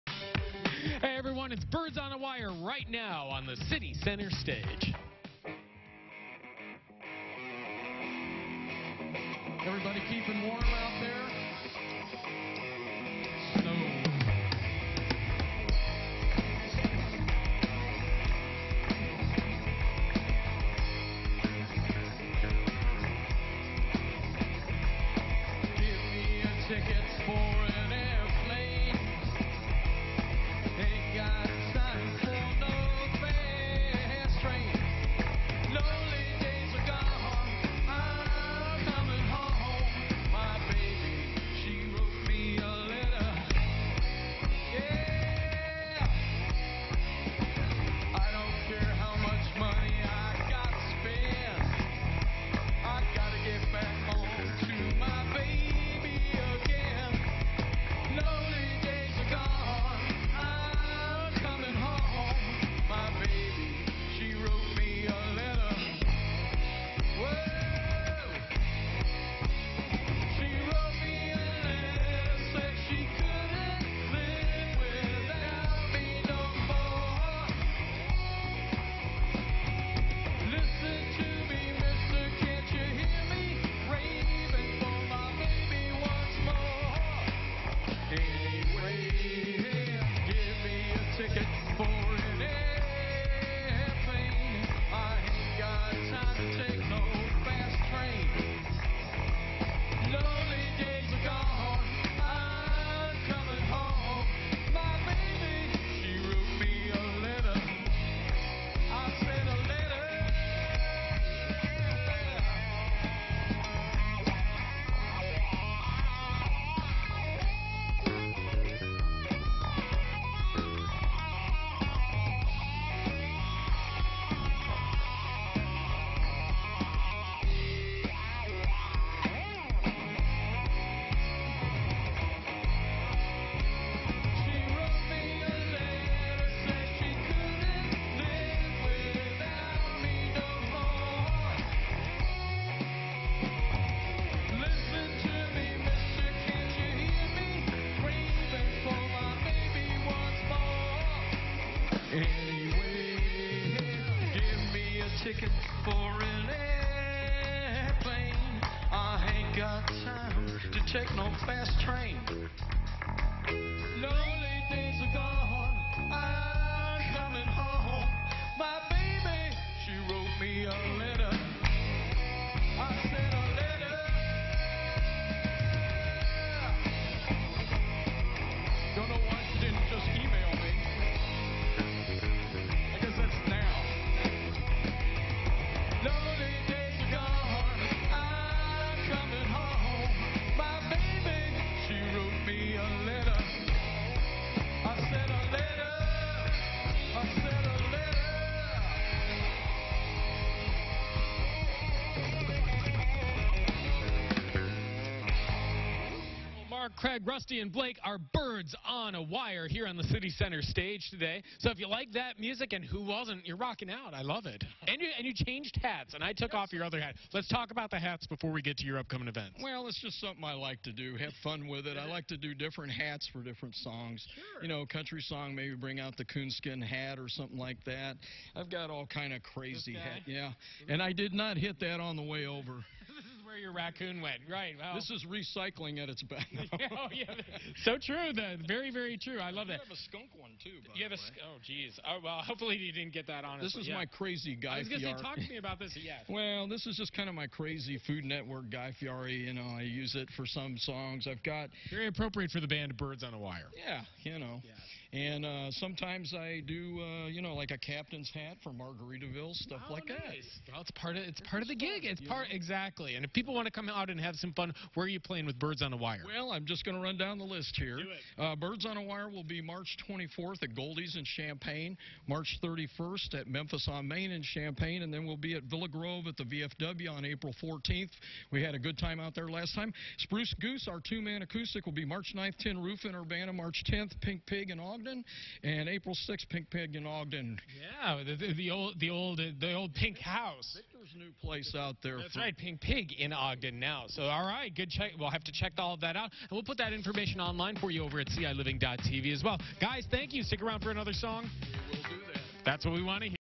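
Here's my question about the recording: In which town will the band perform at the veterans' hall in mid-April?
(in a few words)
Villa Grove.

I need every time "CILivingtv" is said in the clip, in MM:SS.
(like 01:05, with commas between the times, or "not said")
04:58.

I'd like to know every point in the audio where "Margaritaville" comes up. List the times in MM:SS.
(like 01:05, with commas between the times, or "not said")
04:18.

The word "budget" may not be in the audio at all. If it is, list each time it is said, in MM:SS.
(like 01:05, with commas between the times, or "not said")
not said.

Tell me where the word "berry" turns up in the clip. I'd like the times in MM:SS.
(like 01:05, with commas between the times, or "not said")
not said.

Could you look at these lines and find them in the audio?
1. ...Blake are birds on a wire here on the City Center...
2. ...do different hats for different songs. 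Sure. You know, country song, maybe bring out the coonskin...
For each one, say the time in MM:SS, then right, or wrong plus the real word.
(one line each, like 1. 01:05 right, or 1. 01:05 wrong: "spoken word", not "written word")
1. 03:27 right
2. 03:42 right.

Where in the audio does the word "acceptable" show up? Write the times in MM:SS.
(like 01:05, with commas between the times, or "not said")
not said.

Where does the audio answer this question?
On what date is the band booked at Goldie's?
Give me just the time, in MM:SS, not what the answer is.
04:29.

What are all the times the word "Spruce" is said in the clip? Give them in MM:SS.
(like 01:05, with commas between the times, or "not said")
04:40.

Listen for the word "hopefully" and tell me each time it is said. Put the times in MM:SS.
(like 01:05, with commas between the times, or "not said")
04:02.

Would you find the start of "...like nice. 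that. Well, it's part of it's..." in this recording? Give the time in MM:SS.
04:19.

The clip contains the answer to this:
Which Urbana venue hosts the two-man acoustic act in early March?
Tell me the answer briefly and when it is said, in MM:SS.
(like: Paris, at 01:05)
Tin Roof, at 04:42.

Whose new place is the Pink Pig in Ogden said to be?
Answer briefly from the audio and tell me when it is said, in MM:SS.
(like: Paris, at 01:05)
Victor, at 04:50.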